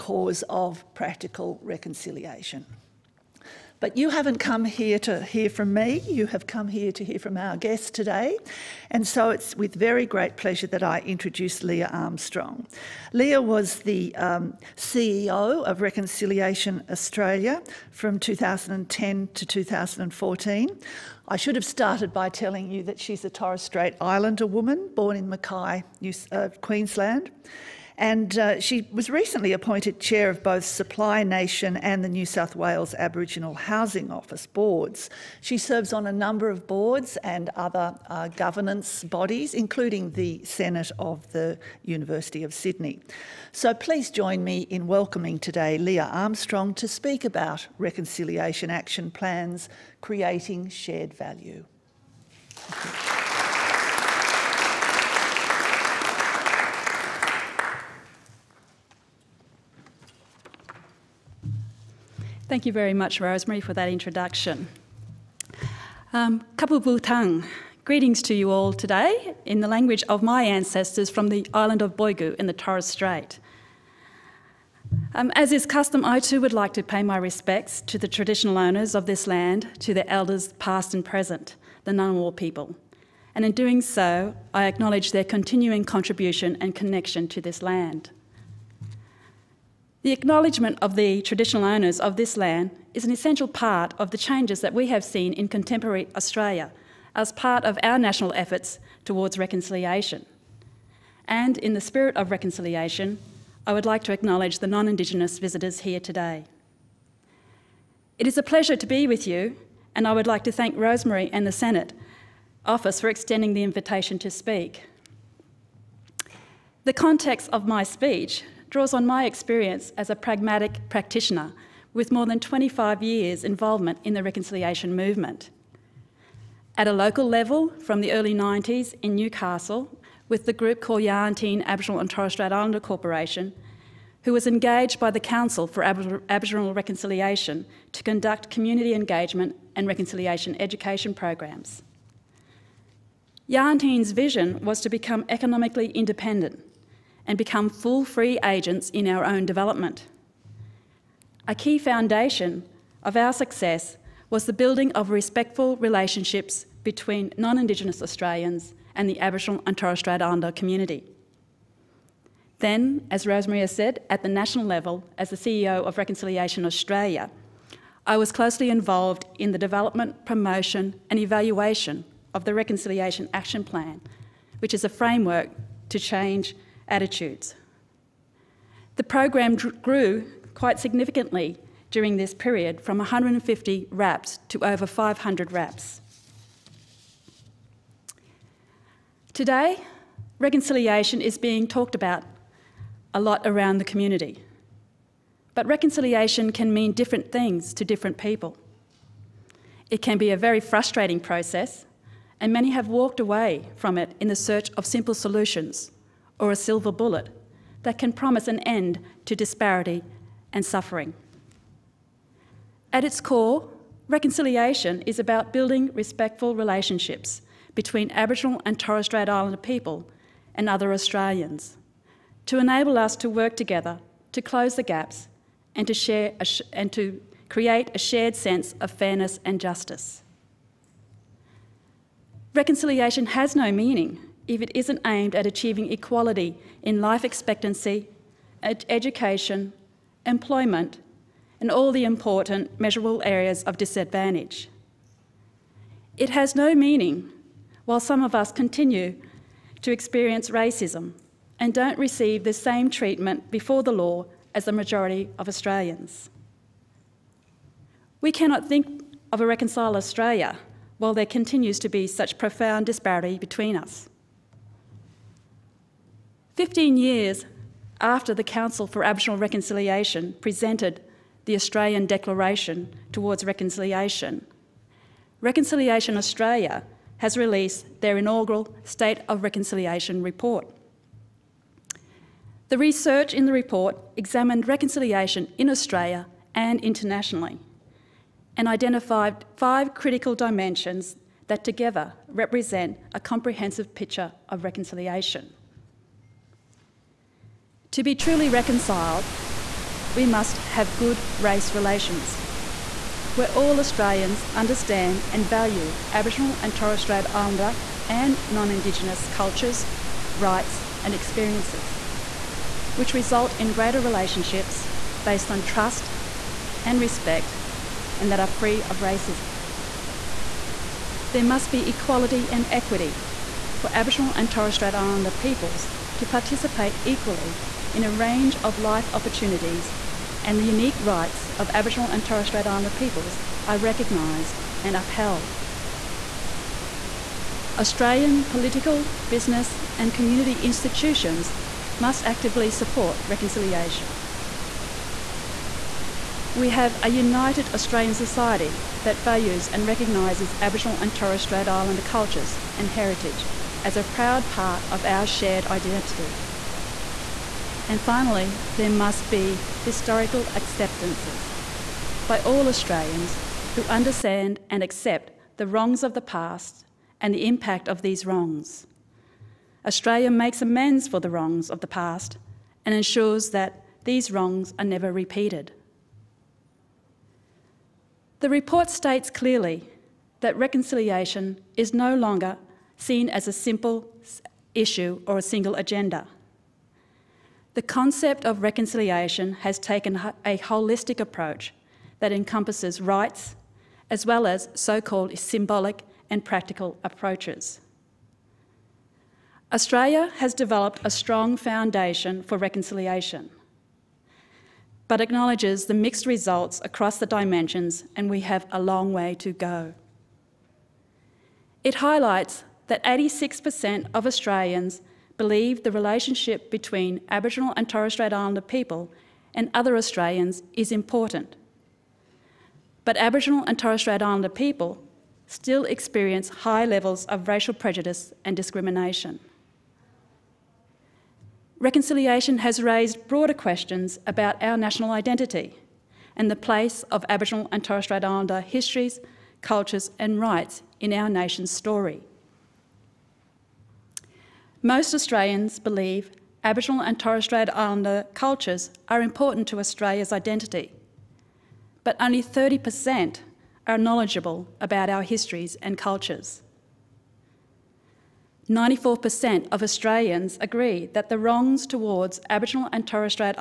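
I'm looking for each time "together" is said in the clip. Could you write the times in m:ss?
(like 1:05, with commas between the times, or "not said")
3:43, 4:51.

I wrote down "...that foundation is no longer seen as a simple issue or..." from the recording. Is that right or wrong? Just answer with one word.
wrong.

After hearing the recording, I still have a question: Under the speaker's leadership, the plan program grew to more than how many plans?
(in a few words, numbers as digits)
500.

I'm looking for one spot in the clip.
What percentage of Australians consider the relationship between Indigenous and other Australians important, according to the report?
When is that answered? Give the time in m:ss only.
6:53.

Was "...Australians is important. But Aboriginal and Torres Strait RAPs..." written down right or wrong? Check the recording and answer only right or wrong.
wrong.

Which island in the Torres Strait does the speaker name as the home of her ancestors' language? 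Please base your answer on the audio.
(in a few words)
Boigu.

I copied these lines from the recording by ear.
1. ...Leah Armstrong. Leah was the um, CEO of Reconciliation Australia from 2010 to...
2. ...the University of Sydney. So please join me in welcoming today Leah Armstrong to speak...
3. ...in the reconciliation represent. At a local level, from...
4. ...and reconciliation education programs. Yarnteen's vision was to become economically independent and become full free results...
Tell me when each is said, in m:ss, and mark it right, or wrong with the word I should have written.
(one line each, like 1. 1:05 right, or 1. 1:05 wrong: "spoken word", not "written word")
1. 0:11 right
2. 0:41 right
3. 2:04 wrong: "movement", not "represent"
4. 2:19 wrong: "agents", not "results".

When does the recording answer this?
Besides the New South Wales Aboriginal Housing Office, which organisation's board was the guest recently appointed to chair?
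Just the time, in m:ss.
0:30.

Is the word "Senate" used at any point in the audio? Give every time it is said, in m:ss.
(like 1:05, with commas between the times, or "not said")
0:40, 1:51.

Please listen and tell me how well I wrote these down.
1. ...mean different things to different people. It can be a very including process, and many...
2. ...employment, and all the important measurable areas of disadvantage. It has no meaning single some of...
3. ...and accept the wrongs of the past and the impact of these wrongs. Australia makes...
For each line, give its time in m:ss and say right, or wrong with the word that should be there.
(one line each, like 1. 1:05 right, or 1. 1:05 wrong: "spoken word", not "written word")
1. 3:16 wrong: "frustrating", not "including"
2. 4:00 wrong: "while", not "single"
3. 6:04 right.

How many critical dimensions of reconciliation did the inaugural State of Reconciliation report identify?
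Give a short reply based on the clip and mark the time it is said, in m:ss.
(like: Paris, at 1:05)
5, at 4:49.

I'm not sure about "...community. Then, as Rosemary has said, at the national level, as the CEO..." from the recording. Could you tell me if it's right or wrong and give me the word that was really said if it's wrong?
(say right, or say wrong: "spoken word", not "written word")
right.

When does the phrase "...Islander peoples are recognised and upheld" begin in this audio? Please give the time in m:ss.
5:32.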